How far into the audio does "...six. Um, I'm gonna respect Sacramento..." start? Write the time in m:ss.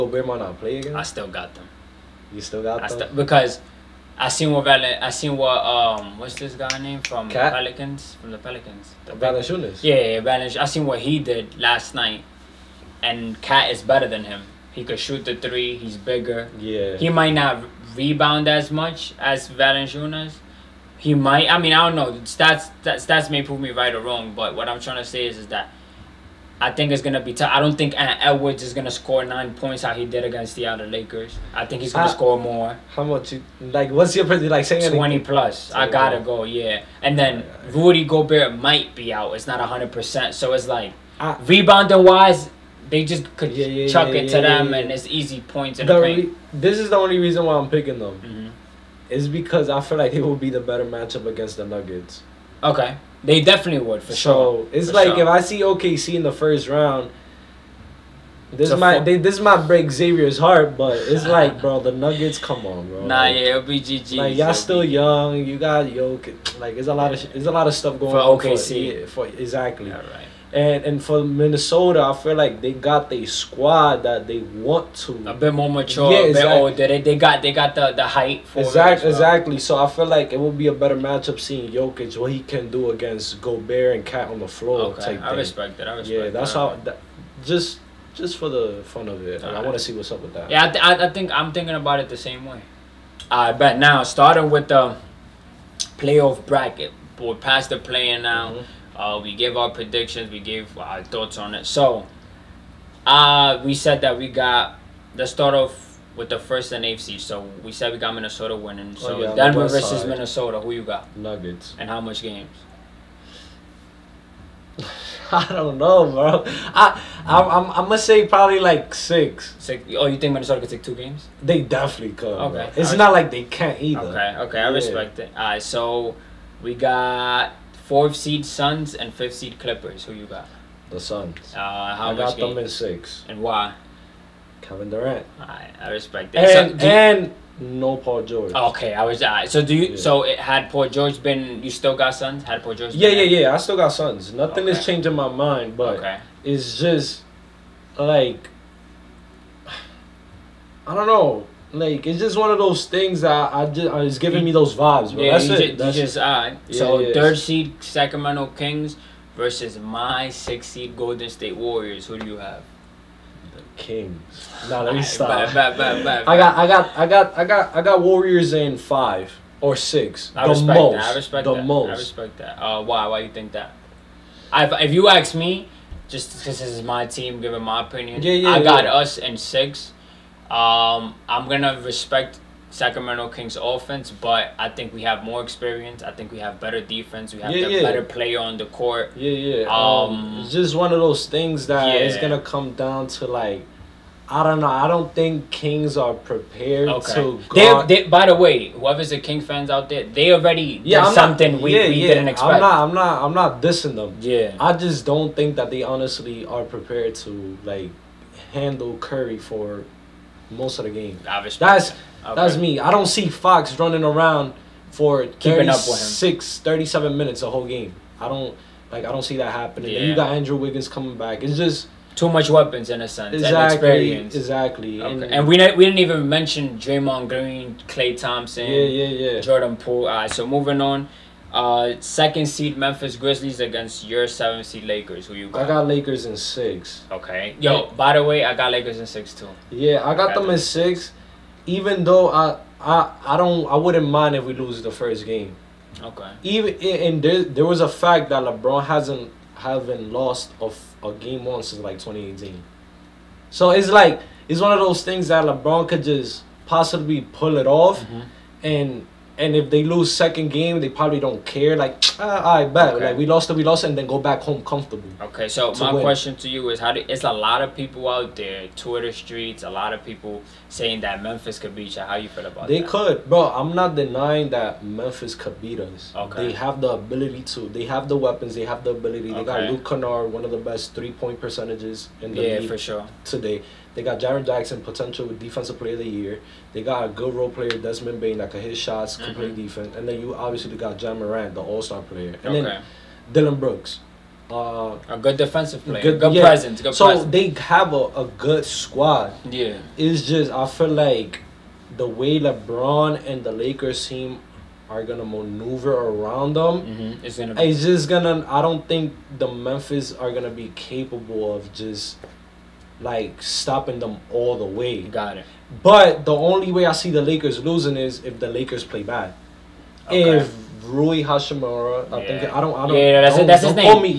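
2:59.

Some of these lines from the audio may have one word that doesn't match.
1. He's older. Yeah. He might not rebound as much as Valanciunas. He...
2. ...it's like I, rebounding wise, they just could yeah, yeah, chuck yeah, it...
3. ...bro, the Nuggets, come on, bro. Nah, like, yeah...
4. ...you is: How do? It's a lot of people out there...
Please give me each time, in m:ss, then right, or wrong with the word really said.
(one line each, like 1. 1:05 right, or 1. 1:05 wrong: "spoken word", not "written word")
1. 0:15 wrong: "bigger", not "older"
2. 0:40 right
3. 1:01 right
4. 4:26 right.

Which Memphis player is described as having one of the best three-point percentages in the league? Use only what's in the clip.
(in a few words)
Luke Kennard.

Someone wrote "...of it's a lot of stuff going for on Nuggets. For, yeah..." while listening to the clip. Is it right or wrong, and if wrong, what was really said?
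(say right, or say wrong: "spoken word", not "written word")
wrong: "OKC", not "Nuggets".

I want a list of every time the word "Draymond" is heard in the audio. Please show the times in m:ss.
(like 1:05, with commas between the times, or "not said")
3:46.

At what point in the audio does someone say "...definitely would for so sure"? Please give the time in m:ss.
0:53.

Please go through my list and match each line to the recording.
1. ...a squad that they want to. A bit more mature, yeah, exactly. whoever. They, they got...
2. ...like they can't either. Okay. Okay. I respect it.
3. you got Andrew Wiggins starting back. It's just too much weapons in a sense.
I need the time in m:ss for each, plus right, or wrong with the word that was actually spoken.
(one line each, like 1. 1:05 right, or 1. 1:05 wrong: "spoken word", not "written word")
1. 1:13 wrong: "older", not "whoever"
2. 2:03 right
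3. 3:40 wrong: "coming", not "starting".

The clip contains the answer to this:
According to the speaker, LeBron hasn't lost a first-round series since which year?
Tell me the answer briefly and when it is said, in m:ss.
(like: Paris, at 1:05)
2018, at 4:11.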